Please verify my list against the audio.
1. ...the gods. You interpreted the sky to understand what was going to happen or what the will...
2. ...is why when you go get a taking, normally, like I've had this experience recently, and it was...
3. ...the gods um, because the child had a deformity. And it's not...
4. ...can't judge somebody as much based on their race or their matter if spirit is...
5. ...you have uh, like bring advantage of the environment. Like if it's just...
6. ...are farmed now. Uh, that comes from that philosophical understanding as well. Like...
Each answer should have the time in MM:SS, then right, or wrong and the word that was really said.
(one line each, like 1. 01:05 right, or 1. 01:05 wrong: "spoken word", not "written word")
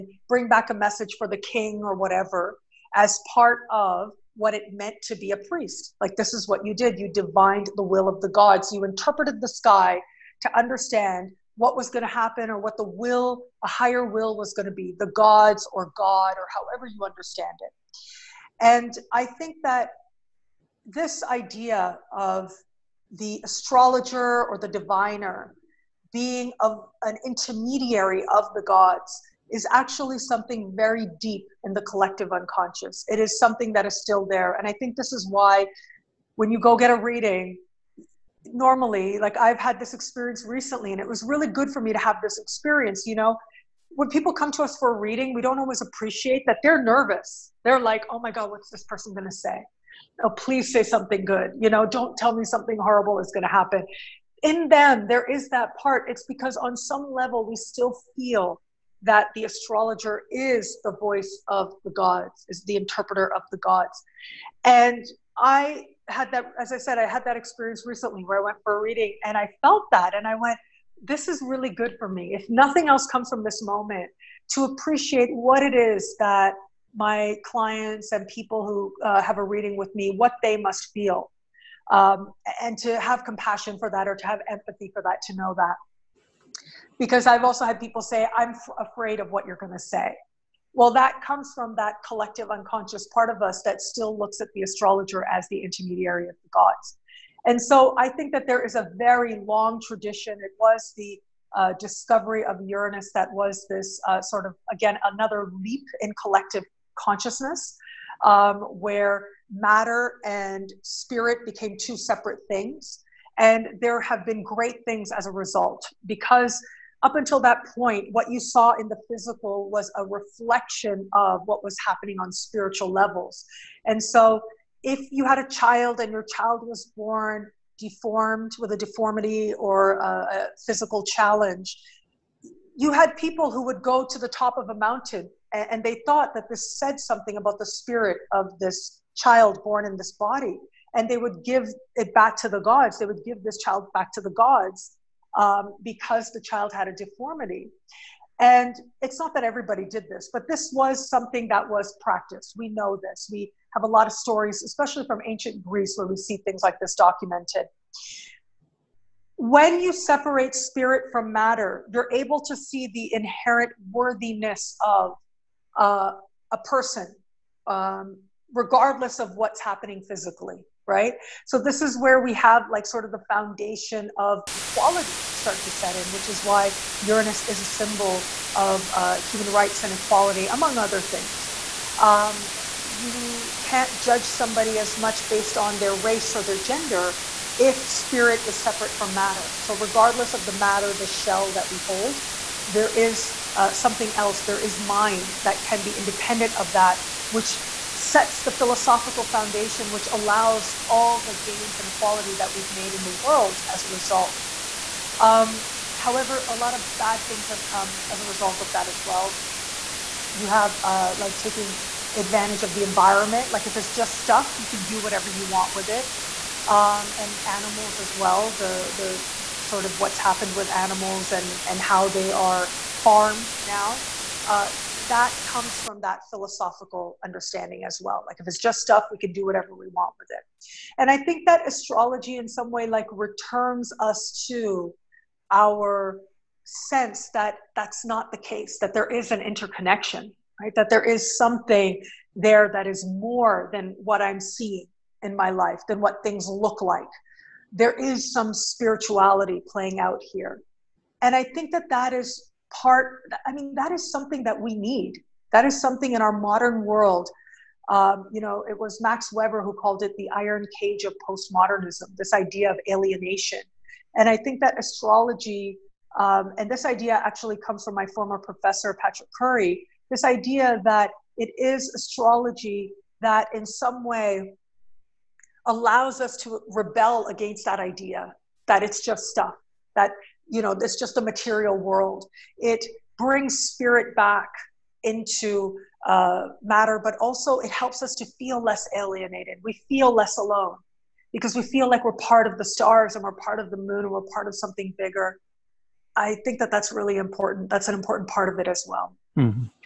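1. 00:08 right
2. 00:35 wrong: "reading", not "taking"
3. 02:24 right
4. 03:03 wrong: "gender", not "matter"
5. 03:30 wrong: "taking", not "bring"
6. 03:42 right.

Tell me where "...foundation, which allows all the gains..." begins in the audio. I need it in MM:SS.
03:19.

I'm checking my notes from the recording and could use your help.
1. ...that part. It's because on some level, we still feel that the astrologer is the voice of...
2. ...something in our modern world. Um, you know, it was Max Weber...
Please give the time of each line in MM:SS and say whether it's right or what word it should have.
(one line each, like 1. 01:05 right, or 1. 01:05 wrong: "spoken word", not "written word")
1. 00:55 right
2. 04:15 right.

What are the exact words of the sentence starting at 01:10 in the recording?
And I went, this is really good for me.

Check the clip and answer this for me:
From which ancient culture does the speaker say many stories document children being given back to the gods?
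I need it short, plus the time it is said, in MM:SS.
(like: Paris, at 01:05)
ancient Greece, at 02:35.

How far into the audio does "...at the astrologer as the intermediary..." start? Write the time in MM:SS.
01:34.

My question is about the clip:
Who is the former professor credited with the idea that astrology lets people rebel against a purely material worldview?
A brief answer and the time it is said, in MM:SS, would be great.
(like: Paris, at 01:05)
Patrick Curry, at 04:28.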